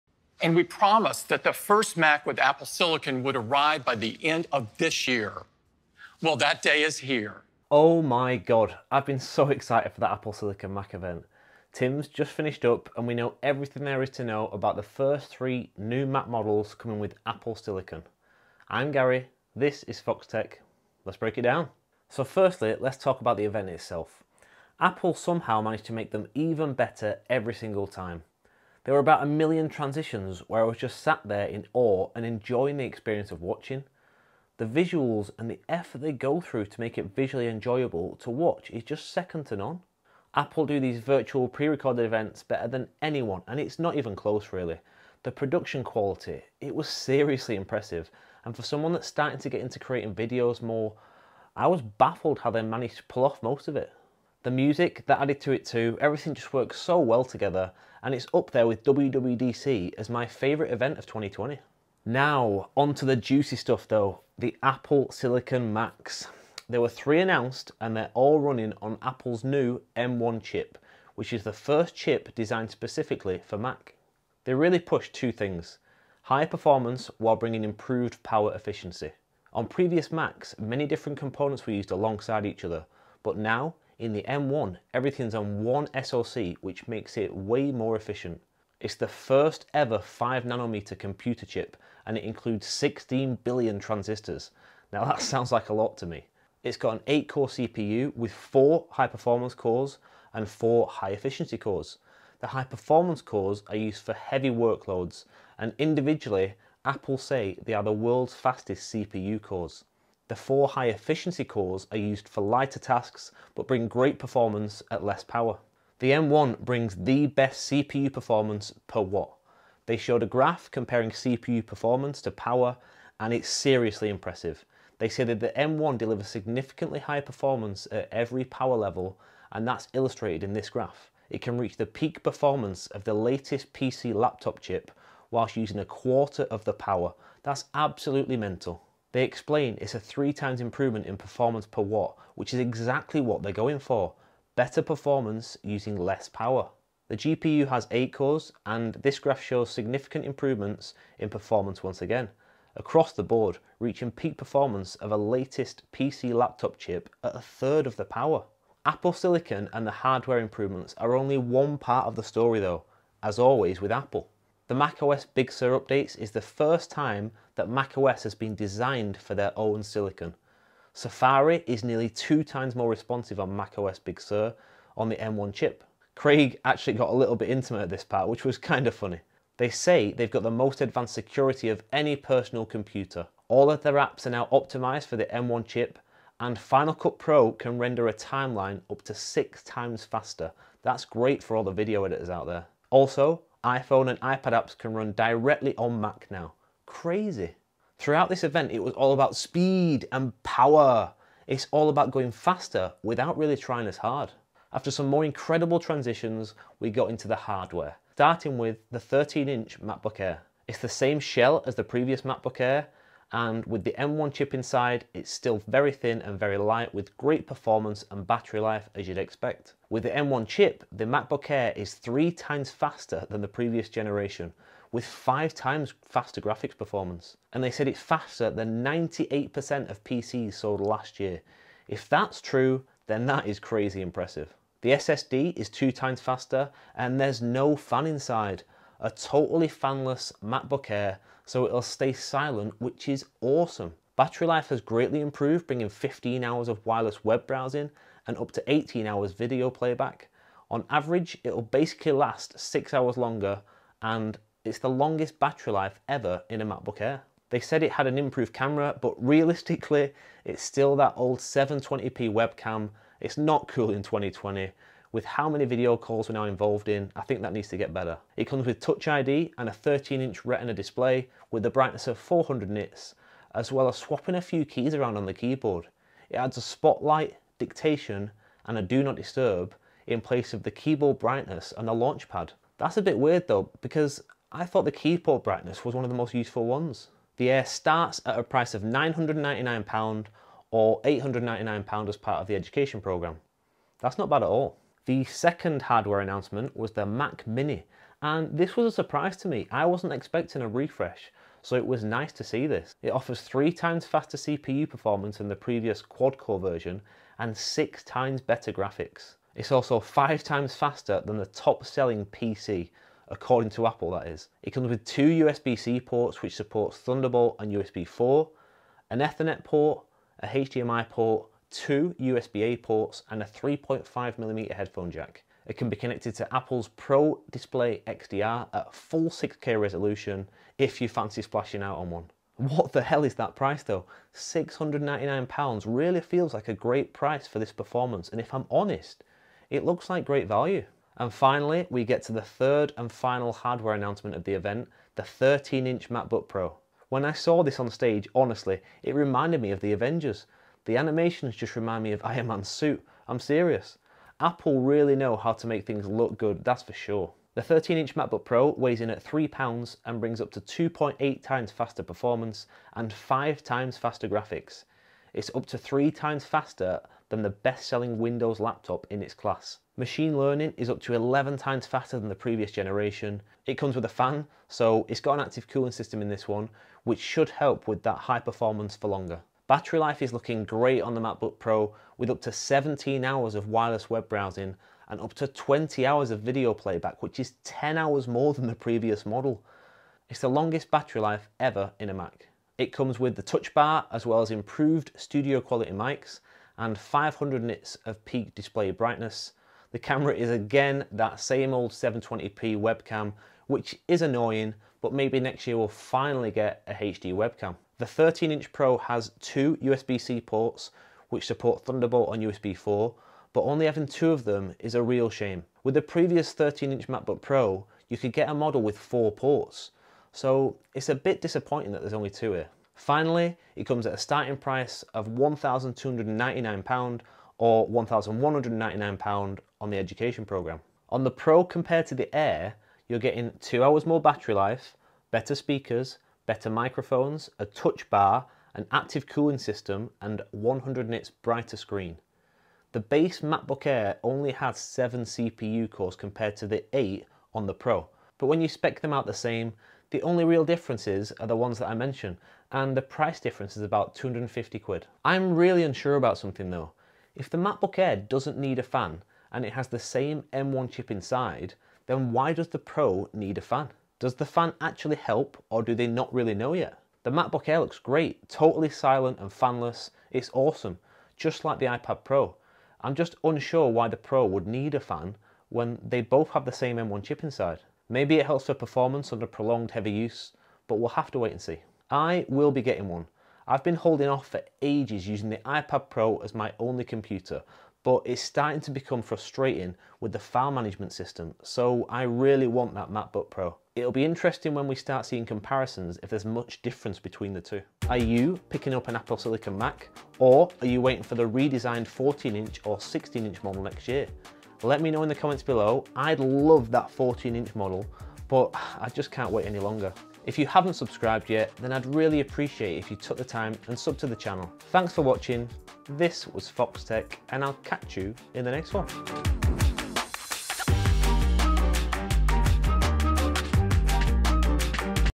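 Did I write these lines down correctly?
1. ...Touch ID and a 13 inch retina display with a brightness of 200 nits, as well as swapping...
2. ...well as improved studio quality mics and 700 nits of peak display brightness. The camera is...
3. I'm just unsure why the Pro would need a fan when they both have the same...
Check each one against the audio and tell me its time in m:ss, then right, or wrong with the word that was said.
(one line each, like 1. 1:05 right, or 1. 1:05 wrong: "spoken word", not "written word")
1. 4:28 wrong: "400", not "200"
2. 6:34 wrong: "500", not "700"
3. 7:53 right.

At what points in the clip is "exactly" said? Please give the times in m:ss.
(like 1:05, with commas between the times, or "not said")
2:22.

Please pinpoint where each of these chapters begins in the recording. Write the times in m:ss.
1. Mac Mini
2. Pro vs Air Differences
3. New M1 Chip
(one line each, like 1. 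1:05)
1. 4:55
2. 7:11
3. 1:02.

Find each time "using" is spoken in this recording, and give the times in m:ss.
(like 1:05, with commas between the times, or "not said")
2:15, 2:25, 8:05.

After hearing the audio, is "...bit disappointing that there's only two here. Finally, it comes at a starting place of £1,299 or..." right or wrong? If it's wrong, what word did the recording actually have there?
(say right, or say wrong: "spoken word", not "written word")
wrong: "price", not "place".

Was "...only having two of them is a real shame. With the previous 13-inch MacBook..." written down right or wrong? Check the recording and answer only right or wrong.
right.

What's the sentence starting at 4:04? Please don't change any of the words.
Battery life has greatly improved, bringing 15 hours of wireless web browsing and up to 18 hours video playback.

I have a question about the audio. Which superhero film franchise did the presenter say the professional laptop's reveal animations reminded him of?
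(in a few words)
The Avengers.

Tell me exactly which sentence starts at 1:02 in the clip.
Now, onto the juicy stuff though, the Apple Silicon Macs.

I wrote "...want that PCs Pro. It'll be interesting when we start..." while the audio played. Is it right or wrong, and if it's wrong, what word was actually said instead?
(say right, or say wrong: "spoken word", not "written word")
wrong: "MacBook", not "PCs".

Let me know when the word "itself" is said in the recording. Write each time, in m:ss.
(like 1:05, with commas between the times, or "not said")
0:23.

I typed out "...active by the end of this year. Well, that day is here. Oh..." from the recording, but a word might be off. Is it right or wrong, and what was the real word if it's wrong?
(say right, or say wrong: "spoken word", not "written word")
wrong: "arrive", not "active".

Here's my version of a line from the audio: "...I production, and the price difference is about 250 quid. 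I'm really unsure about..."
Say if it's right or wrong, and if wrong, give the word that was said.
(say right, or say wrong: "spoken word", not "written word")
wrong: "mention", not "production".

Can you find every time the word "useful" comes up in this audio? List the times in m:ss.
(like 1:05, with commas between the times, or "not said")
4:46.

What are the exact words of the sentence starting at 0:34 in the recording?
The visuals and the effort they go through to make it visually enjoyable to watch is just second to none.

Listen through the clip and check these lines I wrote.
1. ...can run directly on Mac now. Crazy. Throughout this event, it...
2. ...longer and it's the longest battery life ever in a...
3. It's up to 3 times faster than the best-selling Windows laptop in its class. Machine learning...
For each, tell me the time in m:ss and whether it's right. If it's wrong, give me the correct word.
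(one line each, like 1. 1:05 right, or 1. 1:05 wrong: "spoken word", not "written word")
1. 3:14 right
2. 4:13 right
3. 6:05 right.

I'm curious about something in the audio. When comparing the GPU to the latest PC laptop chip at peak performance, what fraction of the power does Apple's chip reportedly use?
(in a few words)
a third.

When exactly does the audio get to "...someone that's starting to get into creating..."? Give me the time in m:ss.
0:48.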